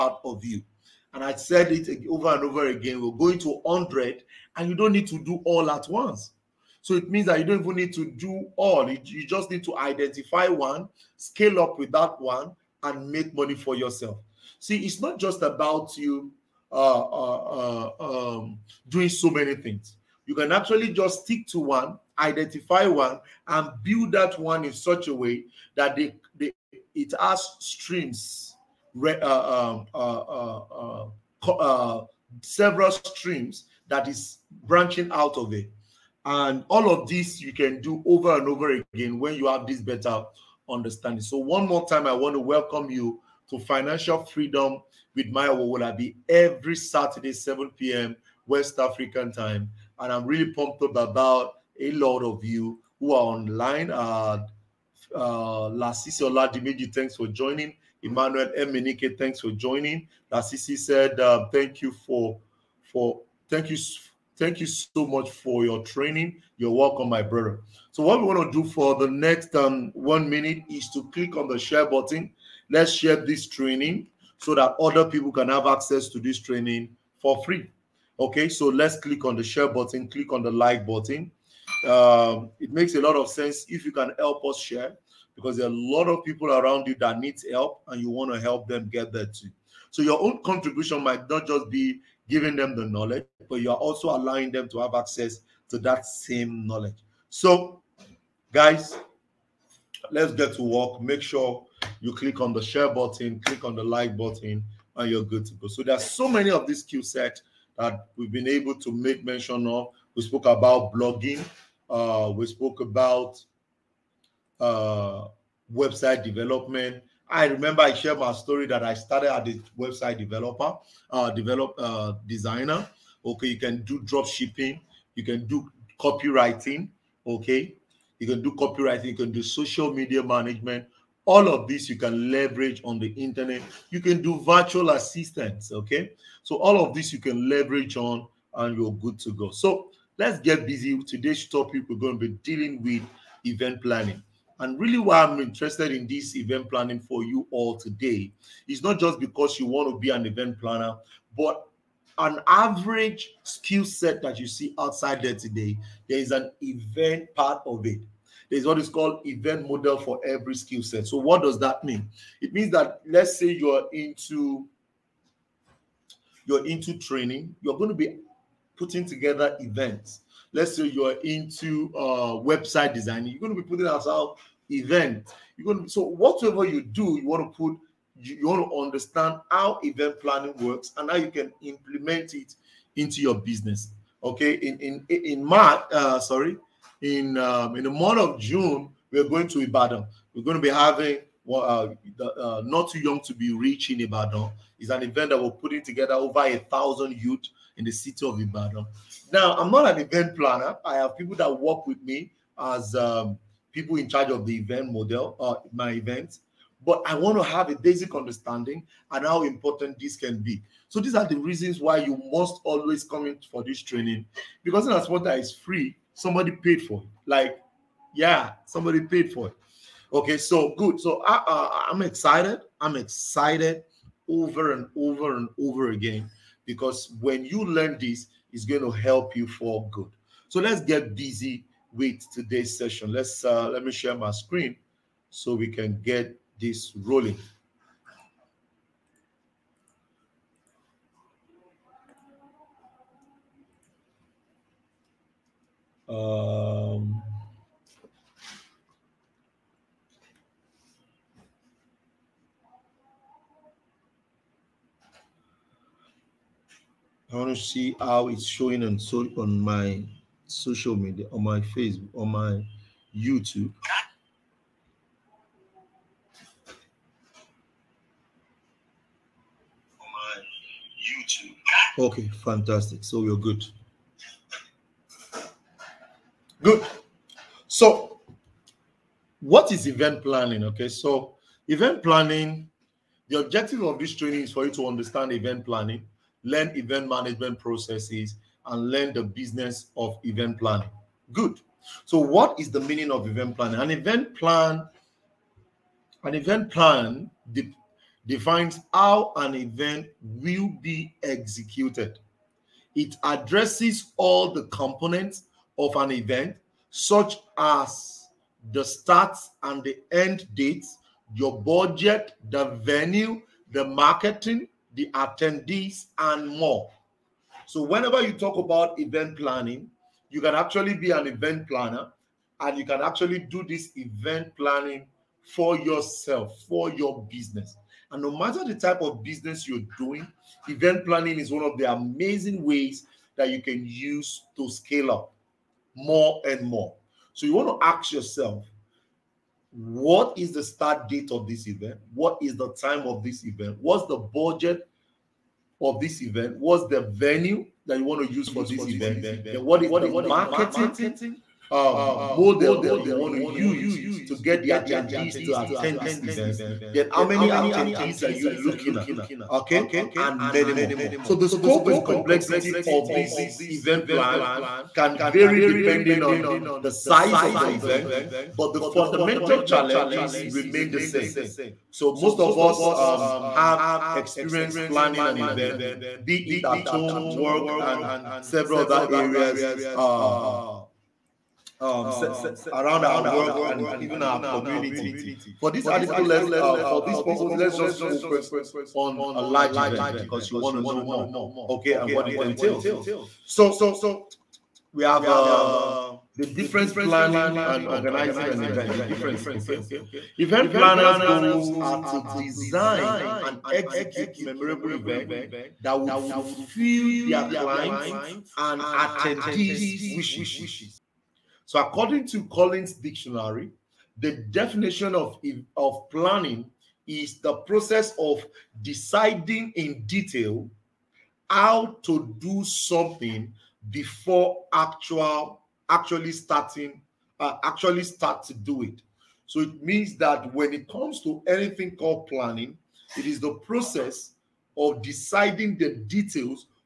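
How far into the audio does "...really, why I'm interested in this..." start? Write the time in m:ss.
2:24.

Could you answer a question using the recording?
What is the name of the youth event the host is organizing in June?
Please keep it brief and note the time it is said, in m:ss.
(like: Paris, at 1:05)
Not too young to be rich, at 3:12.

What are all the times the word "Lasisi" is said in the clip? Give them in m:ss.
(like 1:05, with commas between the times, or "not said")
0:55, 1:00.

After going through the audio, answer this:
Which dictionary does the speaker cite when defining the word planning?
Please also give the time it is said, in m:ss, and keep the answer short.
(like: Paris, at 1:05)
Collins, at 6:52.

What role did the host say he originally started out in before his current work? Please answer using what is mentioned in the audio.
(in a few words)
website developer.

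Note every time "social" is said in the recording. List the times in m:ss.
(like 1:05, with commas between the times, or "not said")
2:09, 4:20.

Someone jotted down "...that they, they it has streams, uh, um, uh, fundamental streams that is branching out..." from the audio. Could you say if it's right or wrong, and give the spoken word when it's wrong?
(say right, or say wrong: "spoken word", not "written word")
wrong: "several", not "fundamental".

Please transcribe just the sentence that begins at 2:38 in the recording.
There's what is called event model for every skill set.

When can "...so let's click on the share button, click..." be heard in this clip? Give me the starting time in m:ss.
1:18.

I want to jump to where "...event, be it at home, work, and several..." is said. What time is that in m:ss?
6:15.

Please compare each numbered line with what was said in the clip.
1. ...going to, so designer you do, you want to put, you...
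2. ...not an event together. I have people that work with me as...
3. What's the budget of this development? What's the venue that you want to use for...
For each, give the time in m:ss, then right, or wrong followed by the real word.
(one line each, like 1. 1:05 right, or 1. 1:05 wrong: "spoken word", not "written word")
1. 2:55 wrong: "whatever", not "designer"
2. 3:19 wrong: "planner", not "together"
3. 5:43 wrong: "event", not "development".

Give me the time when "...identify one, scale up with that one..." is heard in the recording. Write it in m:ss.
0:09.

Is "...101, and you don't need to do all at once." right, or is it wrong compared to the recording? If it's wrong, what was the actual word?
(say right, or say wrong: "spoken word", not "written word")
wrong: "100", not "101".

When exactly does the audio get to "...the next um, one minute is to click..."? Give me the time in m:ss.
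1:08.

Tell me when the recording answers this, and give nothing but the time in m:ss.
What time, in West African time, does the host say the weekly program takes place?
0:47.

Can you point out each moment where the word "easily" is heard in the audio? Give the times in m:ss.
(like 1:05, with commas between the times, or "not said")
not said.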